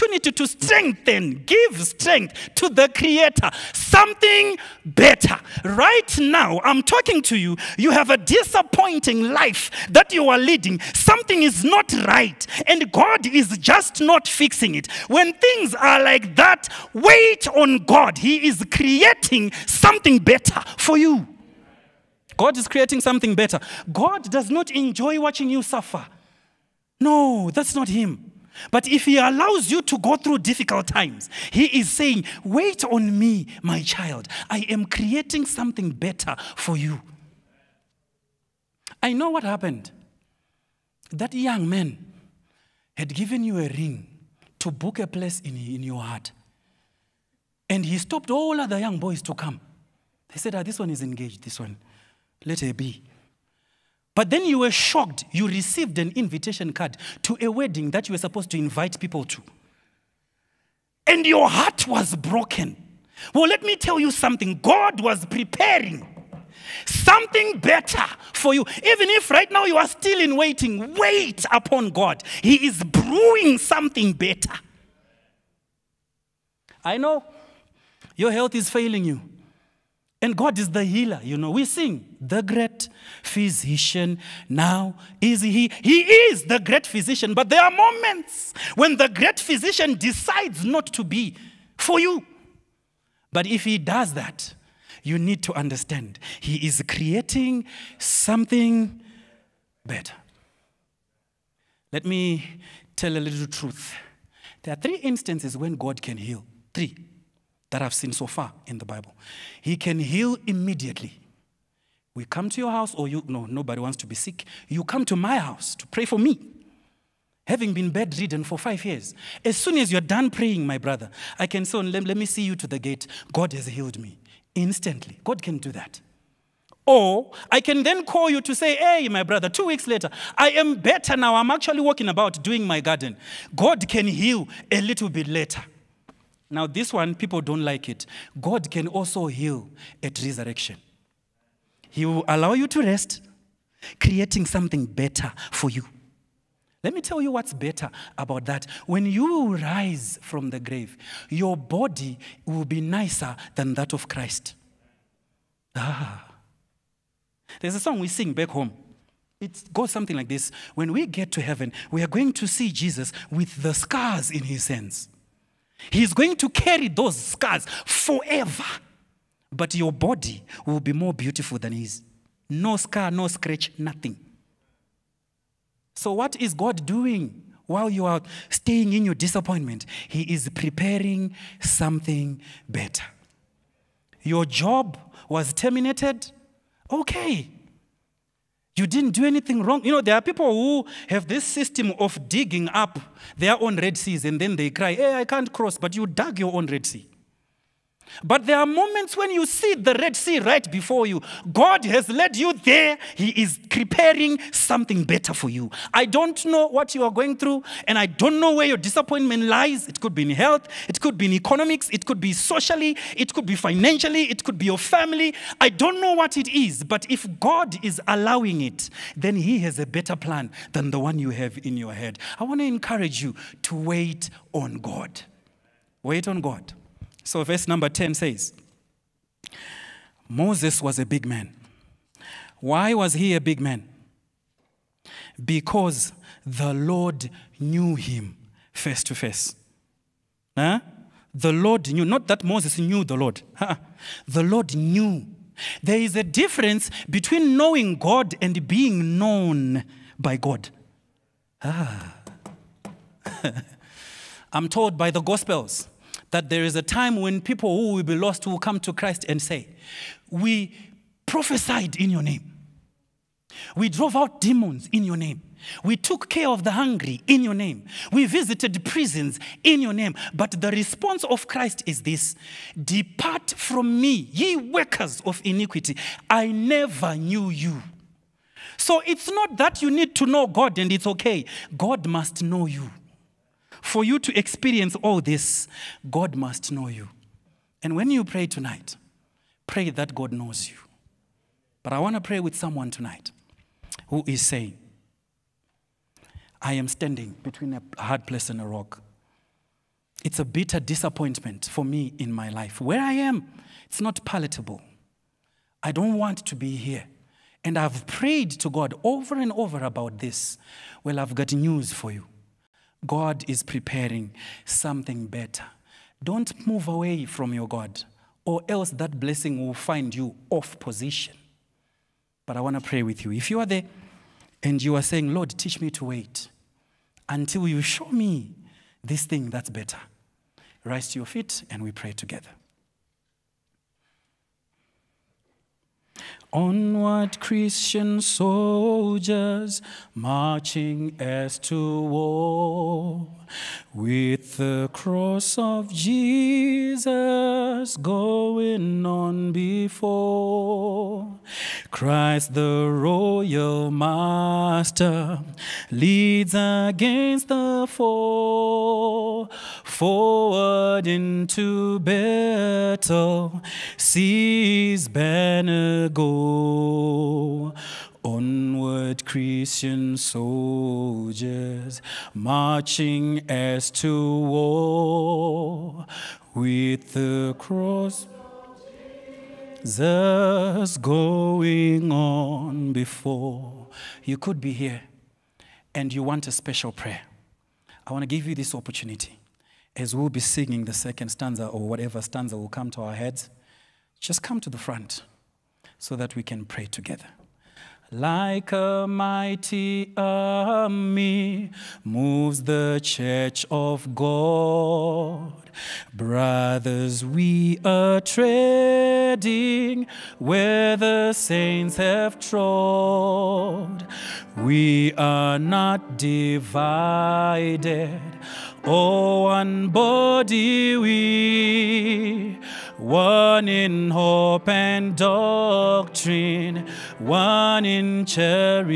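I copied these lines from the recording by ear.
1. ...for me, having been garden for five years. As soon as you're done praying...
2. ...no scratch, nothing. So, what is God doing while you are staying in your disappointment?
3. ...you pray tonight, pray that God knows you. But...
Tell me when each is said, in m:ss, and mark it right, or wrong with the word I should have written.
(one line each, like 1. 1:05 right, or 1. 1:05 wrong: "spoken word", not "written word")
1. 1:56 wrong: "bedridden", not "garden"
2. 2:53 right
3. 4:48 right.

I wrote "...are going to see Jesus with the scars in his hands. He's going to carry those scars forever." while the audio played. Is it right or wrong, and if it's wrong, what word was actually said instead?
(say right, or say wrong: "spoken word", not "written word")
right.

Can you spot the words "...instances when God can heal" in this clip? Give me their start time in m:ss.
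1:45.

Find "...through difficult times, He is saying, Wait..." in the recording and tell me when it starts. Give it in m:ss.
0:30.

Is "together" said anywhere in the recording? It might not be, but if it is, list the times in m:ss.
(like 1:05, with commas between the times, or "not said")
5:32, 6:36.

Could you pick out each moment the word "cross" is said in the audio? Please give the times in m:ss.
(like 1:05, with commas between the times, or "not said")
3:15, 5:44, 6:17.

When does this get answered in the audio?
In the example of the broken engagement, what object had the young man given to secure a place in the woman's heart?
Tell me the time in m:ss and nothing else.
0:43.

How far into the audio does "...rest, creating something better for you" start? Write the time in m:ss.
2:22.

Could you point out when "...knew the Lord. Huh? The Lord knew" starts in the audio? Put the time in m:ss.
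4:02.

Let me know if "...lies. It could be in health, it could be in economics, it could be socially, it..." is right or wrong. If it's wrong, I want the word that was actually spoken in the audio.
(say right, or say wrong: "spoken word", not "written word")
right.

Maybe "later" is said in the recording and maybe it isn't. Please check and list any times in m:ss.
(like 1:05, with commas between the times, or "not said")
2:09, 2:15.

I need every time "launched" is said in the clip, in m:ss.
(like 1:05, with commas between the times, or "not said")
not said.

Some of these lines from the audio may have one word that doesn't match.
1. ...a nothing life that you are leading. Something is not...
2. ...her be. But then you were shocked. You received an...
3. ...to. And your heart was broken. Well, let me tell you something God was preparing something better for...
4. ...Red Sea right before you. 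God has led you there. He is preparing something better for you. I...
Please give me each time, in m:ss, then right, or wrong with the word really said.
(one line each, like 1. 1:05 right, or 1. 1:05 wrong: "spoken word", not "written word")
1. 0:08 wrong: "disappointing", not "nothing"
2. 0:52 right
3. 0:59 right
4. 3:19 right.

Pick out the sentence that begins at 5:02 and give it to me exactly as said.
Where I am, it's not palatable.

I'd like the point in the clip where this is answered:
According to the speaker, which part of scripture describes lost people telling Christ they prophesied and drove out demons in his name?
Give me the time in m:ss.
4:15.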